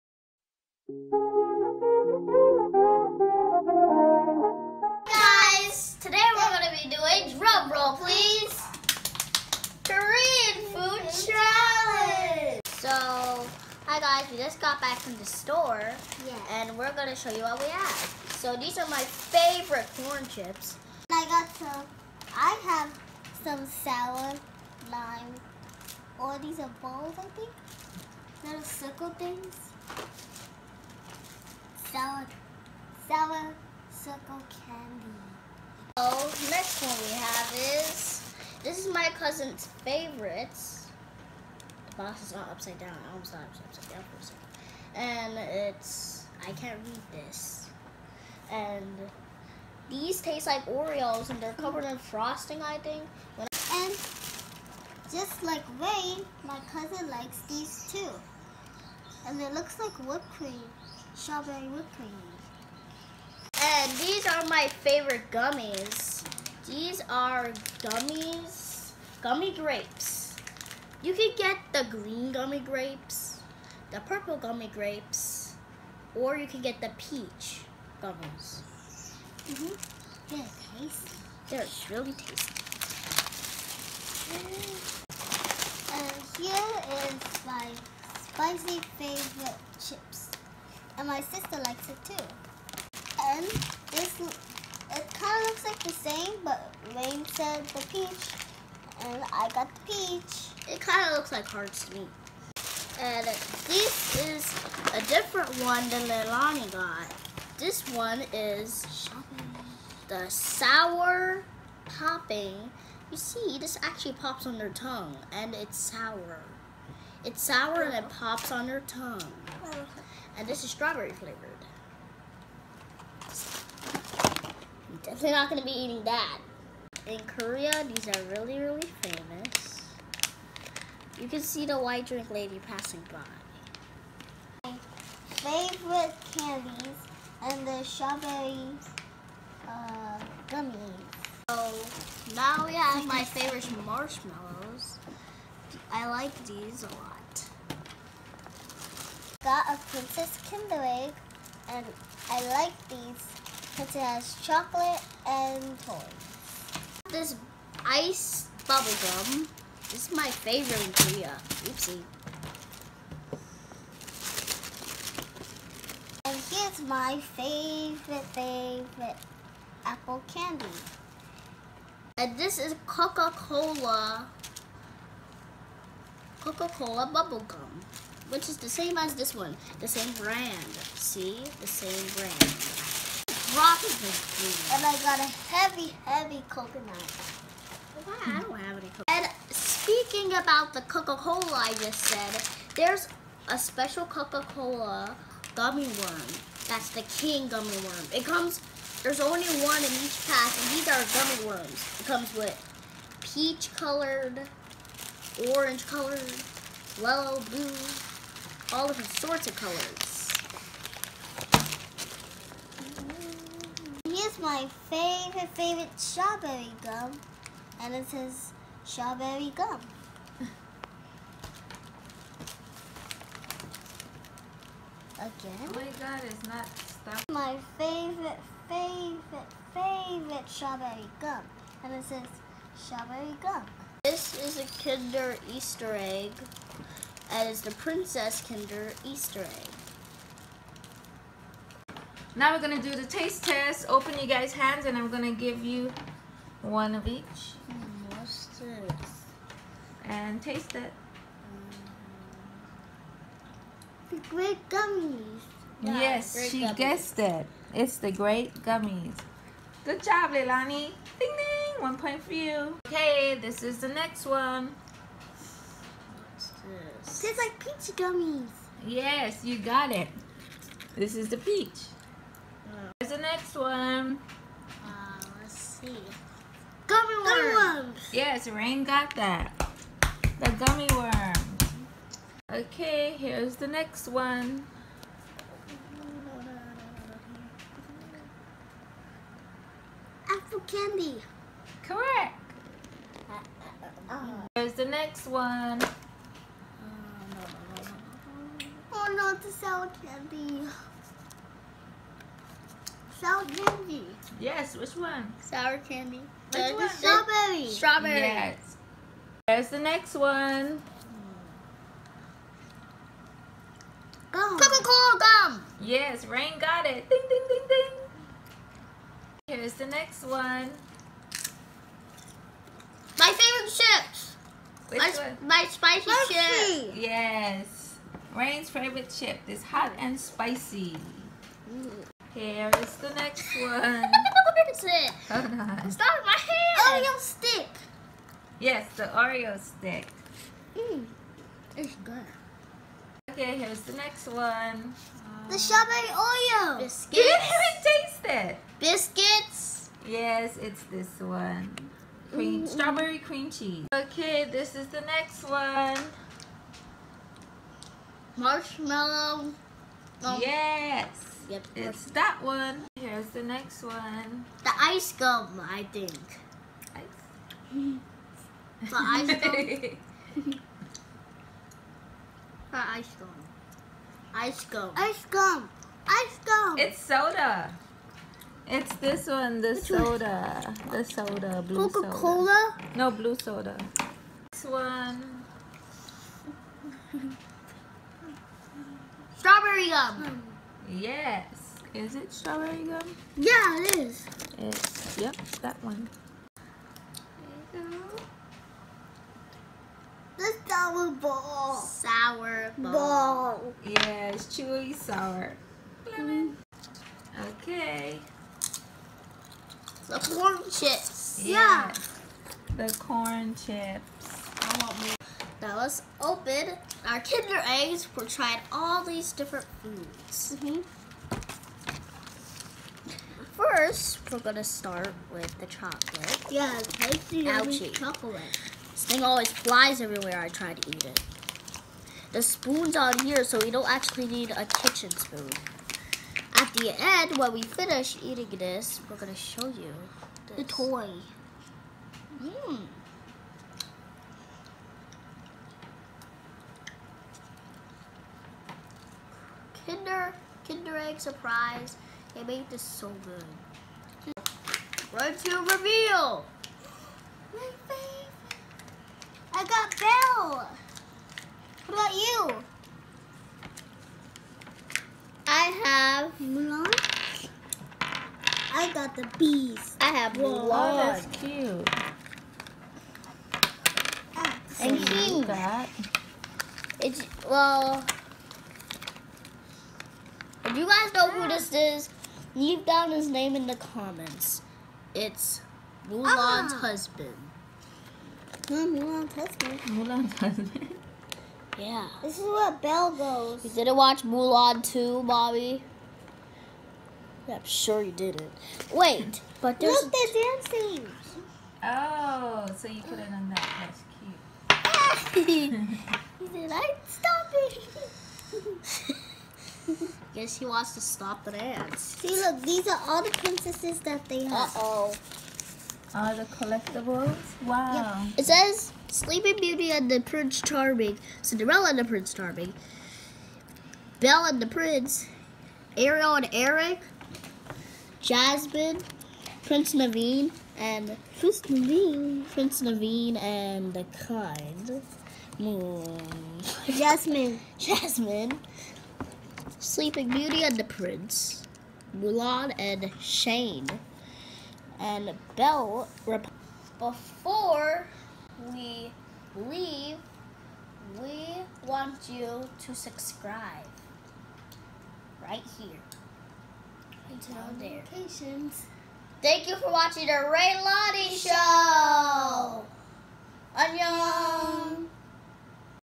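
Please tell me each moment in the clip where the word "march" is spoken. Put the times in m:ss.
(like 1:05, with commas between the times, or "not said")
not said.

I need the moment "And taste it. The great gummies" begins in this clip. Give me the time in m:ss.
4:10.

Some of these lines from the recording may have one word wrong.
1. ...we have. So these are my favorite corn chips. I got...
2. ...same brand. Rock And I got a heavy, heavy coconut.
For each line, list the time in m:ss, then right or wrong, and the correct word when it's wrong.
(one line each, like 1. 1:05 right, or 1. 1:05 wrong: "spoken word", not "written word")
1. 0:17 right
2. 3:01 right.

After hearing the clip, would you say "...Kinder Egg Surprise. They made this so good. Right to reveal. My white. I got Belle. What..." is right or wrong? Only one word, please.
wrong.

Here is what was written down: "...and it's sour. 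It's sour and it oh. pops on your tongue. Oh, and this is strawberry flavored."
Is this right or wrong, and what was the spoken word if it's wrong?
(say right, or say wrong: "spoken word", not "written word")
right.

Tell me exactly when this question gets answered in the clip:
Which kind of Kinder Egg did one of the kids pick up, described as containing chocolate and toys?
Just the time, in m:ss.
2:29.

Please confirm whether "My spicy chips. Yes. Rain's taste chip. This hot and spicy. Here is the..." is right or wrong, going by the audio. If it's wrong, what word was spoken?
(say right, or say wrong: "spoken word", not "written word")
wrong: "favorite", not "taste".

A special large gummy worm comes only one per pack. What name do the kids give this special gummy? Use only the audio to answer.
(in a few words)
King gummy worm.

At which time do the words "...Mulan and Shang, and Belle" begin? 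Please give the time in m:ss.
9:02.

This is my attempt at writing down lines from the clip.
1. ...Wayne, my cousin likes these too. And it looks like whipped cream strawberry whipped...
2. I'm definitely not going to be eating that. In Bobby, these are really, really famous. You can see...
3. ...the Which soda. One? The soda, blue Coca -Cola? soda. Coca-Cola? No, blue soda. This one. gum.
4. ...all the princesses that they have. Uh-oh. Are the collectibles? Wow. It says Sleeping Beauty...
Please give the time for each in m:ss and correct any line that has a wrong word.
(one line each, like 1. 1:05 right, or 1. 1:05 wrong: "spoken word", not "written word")
1. 0:55 right
2. 2:04 wrong: "Korea", not "Bobby"
3. 6:19 right
4. 8:33 right.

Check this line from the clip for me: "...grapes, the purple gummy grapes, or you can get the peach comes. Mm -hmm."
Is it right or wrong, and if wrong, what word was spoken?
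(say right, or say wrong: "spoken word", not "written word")
wrong: "gummies", not "comes".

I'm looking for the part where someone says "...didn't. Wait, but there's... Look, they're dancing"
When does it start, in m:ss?
8:18.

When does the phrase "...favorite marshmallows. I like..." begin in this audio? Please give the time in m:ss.
2:23.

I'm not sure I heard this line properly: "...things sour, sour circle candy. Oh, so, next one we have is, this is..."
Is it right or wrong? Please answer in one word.
right.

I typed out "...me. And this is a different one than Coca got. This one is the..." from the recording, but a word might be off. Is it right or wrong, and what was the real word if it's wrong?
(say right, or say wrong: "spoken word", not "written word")
wrong: "Leilani", not "Coca".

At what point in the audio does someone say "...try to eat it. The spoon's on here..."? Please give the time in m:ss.
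7:10.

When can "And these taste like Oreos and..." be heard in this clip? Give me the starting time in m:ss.
0:48.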